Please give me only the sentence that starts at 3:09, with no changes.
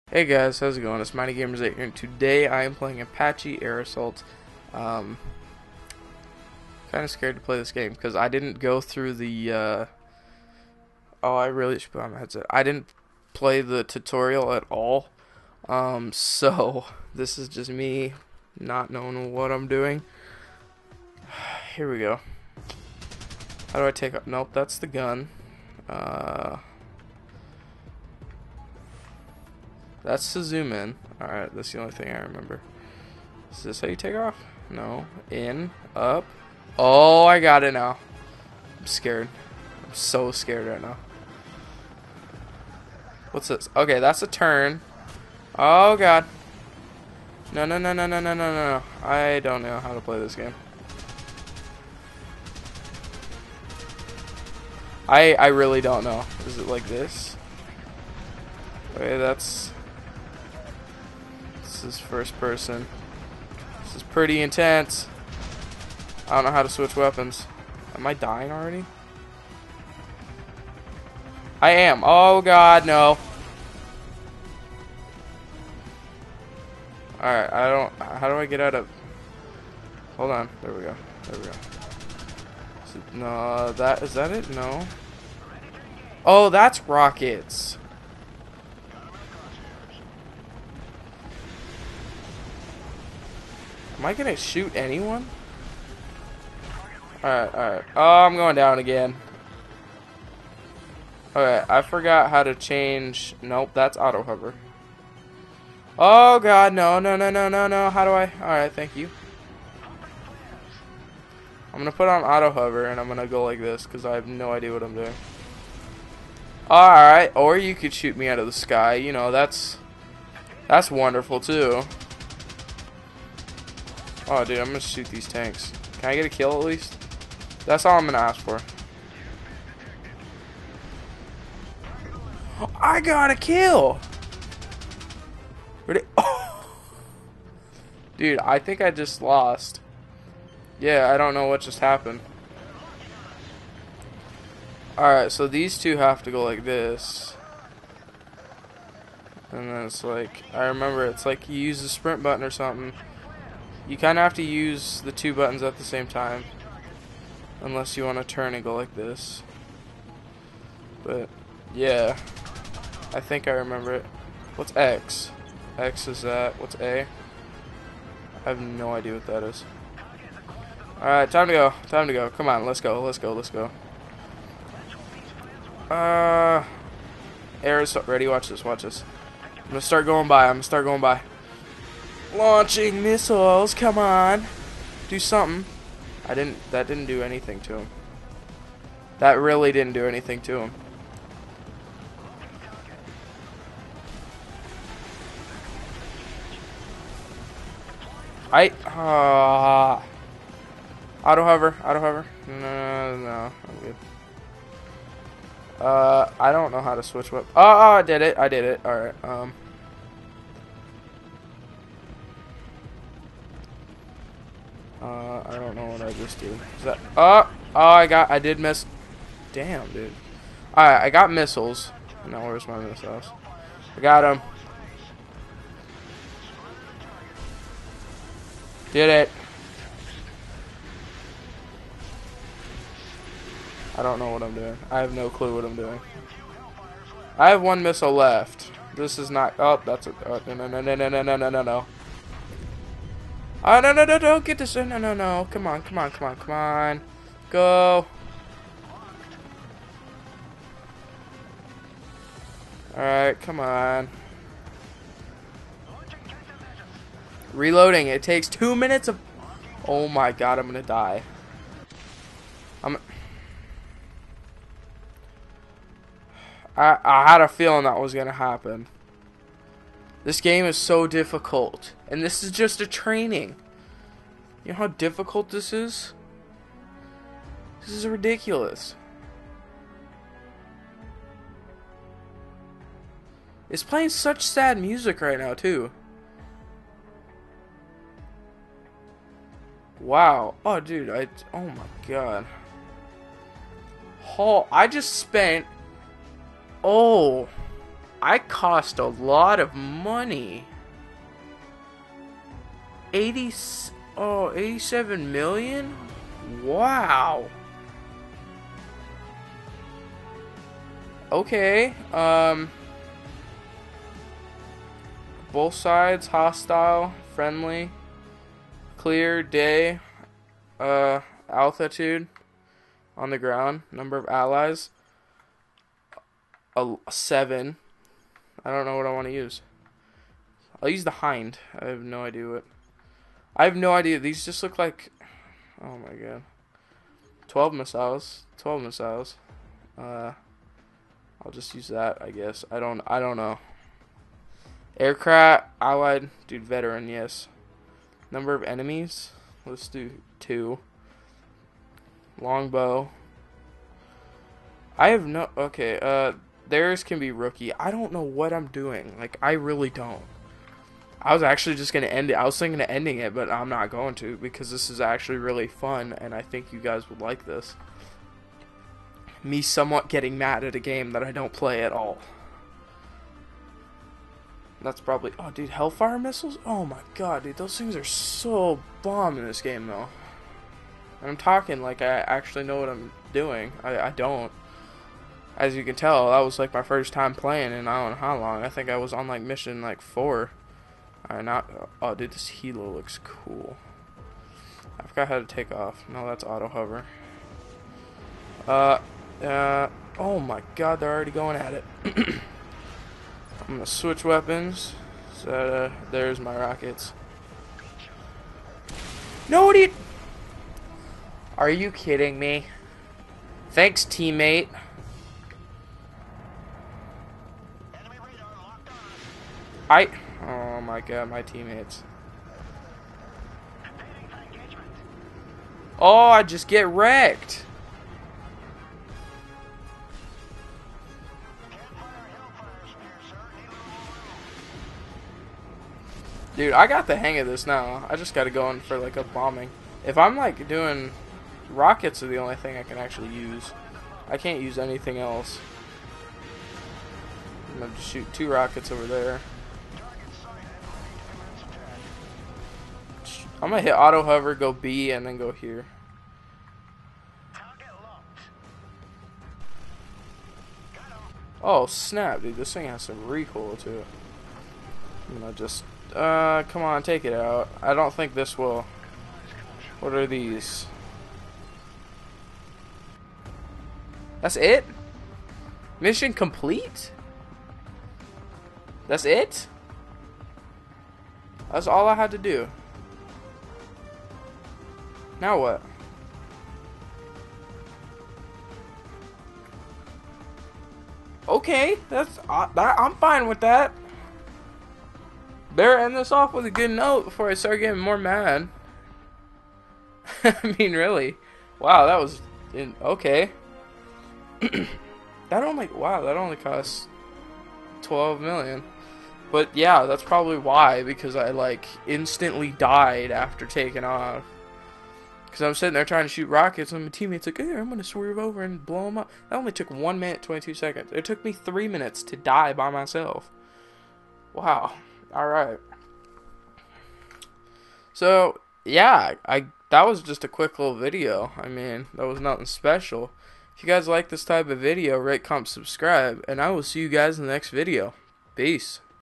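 That really didn't do anything to him.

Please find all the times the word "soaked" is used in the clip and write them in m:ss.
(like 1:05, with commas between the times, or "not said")
not said.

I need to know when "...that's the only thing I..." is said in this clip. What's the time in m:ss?
0:31.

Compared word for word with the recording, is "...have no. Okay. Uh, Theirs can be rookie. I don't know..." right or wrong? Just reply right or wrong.
right.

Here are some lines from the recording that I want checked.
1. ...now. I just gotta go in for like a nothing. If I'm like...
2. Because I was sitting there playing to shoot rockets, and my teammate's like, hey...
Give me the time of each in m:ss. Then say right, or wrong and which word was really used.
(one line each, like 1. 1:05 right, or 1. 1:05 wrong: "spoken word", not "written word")
1. 7:17 wrong: "bombing", not "nothing"
2. 8:35 wrong: "trying", not "playing".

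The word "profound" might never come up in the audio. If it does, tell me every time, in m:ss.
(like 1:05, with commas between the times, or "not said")
not said.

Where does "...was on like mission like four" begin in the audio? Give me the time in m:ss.
6:28.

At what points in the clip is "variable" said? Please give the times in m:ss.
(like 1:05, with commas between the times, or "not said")
not said.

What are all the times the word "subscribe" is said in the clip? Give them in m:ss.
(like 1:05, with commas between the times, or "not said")
8:55.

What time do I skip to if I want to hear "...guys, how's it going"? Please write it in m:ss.
0:00.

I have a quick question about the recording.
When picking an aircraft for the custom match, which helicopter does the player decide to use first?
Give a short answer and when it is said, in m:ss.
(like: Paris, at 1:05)
Hind, at 5:31.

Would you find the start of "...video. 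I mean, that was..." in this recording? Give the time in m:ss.
8:50.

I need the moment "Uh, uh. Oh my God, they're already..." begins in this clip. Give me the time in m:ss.
6:38.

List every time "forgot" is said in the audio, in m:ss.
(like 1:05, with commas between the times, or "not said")
1:41, 6:35.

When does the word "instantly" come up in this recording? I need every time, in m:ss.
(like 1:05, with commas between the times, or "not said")
8:32.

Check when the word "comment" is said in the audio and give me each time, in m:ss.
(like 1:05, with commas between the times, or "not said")
8:55.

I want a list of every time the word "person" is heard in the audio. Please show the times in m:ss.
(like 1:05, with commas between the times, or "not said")
1:02.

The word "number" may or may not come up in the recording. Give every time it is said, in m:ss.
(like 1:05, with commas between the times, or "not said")
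5:23, 5:48.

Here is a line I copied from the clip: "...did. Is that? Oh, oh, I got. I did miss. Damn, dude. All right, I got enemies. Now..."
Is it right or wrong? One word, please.
wrong.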